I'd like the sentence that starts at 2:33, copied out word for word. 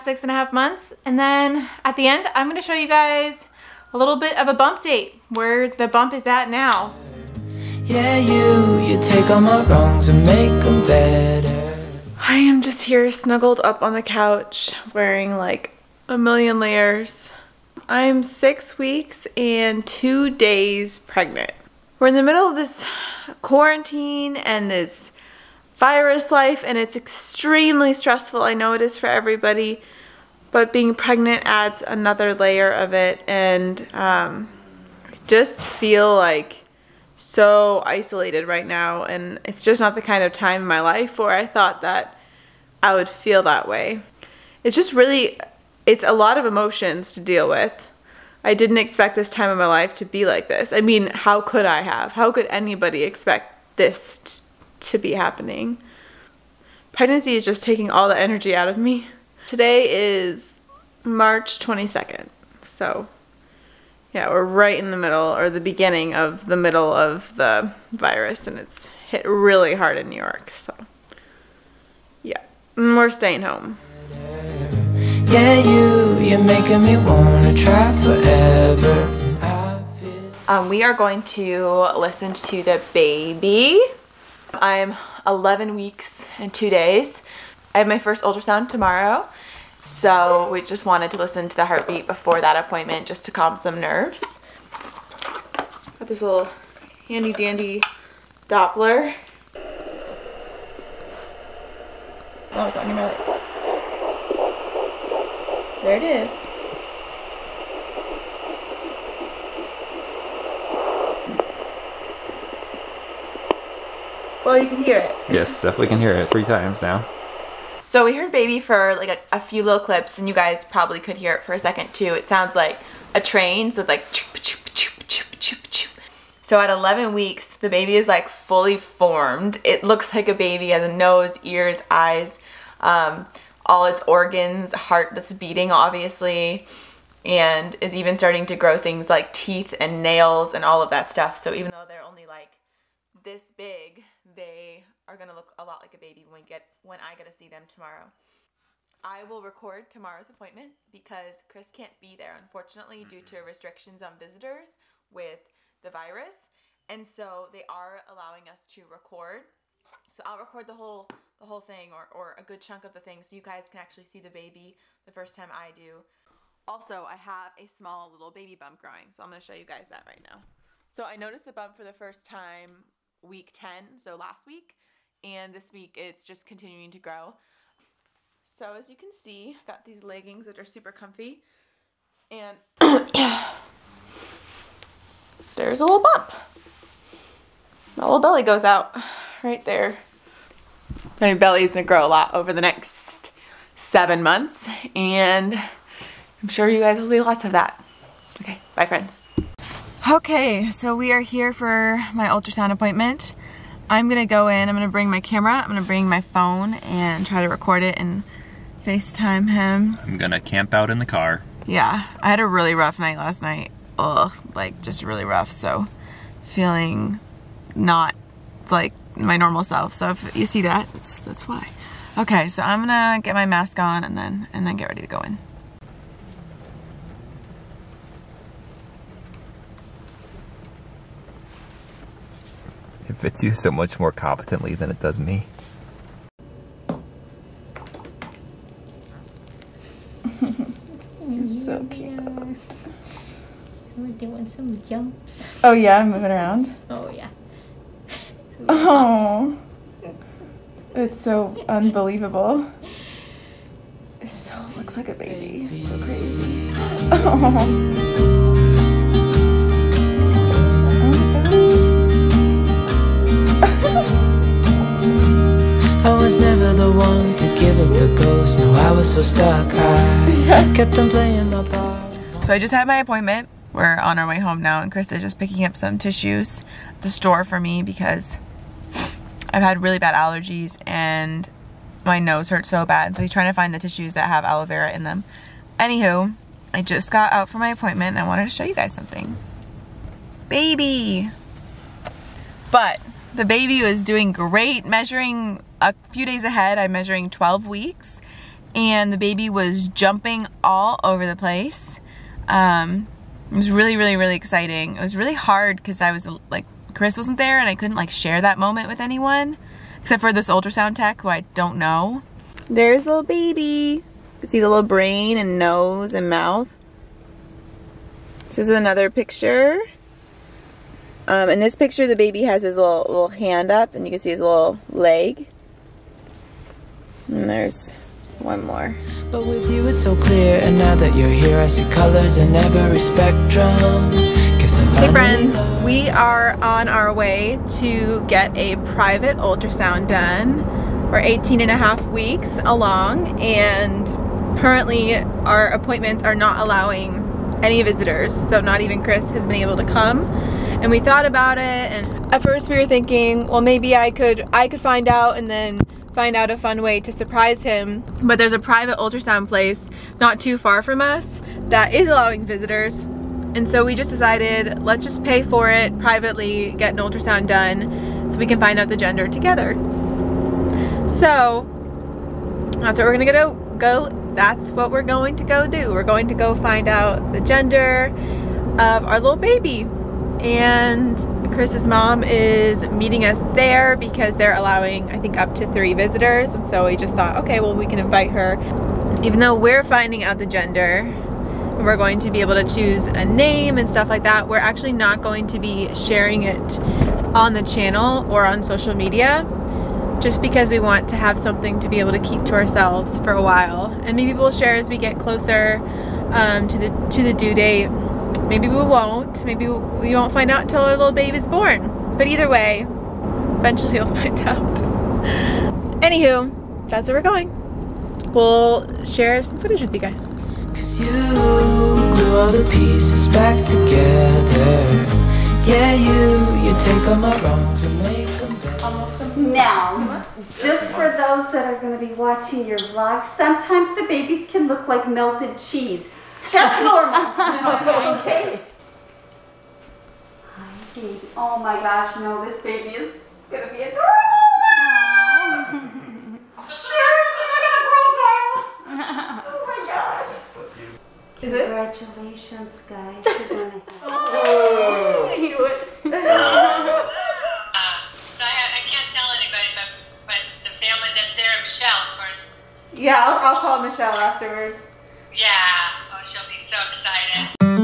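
due to restrictions on visitors with the virus.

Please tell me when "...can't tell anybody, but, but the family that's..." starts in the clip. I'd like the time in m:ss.
7:38.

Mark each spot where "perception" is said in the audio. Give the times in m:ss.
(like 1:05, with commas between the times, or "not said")
not said.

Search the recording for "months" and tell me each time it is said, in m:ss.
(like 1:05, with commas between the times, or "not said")
0:00, 3:14.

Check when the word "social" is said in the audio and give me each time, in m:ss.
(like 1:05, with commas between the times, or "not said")
6:38.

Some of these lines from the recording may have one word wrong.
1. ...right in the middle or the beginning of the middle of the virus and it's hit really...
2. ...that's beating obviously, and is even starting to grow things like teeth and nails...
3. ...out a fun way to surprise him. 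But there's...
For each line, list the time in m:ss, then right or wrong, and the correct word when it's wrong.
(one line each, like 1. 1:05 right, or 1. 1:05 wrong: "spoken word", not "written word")
1. 1:04 right
2. 2:15 right
3. 5:56 right.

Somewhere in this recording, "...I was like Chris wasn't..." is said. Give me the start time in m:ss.
5:05.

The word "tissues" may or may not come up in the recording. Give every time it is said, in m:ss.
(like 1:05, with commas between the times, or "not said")
4:35, 4:43.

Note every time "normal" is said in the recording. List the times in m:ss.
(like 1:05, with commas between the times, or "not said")
3:39, 7:16.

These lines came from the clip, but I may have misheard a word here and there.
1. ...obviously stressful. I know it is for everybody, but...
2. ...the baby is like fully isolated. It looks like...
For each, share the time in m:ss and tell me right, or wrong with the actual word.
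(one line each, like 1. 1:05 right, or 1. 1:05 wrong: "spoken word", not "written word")
1. 0:26 wrong: "extremely", not "obviously"
2. 2:07 wrong: "formed", not "isolated".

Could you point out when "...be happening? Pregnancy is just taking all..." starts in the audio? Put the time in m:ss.
0:54.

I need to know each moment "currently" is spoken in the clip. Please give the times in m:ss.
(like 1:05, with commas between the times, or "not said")
5:44.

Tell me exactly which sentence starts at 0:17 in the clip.
I'm six weeks and two days pregnant.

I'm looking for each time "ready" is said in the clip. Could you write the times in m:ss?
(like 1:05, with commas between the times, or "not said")
3:44.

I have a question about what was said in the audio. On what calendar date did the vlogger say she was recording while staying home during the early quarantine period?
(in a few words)
March 22.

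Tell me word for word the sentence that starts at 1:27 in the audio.
I have my first ultrasound tomorrow.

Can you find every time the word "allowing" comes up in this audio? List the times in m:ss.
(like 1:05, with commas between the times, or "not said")
2:38, 5:46, 6:02, 6:24.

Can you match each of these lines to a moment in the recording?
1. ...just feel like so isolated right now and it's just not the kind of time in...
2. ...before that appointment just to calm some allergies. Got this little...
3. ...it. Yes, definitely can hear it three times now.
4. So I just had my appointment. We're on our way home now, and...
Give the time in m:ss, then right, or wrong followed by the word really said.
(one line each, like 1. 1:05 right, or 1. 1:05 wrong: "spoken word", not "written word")
1. 0:35 right
2. 1:32 wrong: "nerves", not "allergies"
3. 1:54 right
4. 4:32 right.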